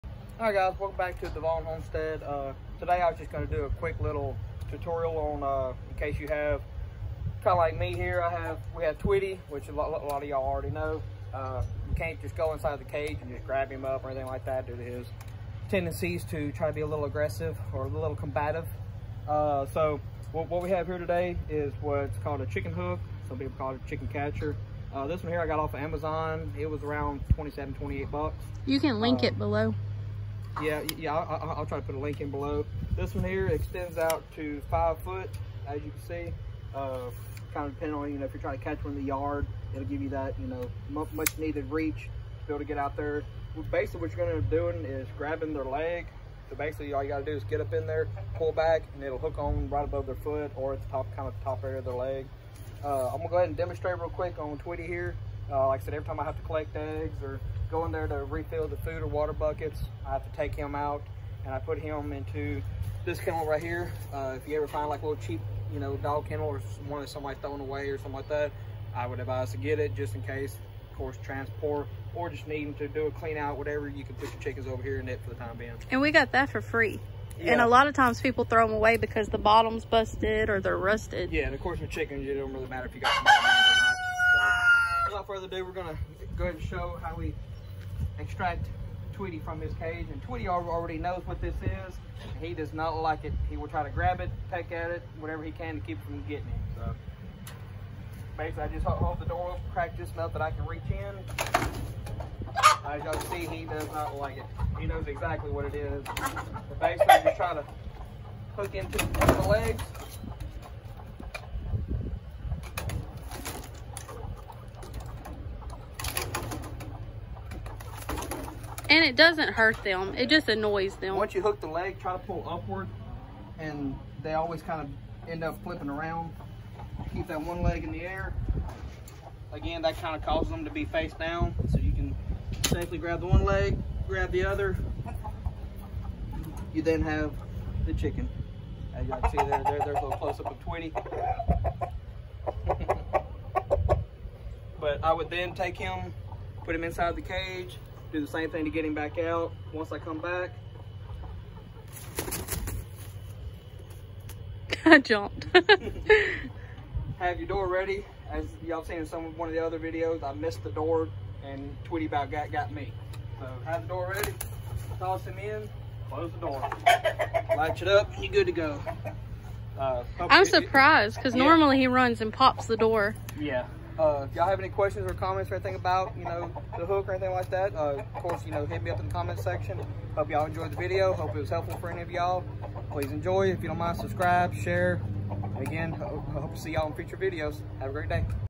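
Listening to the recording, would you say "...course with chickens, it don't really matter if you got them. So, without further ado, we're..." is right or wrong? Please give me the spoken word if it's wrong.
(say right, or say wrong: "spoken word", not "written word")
right.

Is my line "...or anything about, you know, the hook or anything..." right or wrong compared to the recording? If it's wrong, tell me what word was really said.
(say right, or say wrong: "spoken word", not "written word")
right.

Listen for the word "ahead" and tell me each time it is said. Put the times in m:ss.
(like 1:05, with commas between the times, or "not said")
0:53, 1:26.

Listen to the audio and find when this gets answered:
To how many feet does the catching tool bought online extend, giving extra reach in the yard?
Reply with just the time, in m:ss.
0:34.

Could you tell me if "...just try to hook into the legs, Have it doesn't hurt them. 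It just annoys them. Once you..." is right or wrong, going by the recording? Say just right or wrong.
wrong.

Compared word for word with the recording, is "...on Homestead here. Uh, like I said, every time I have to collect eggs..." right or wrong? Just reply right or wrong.
wrong.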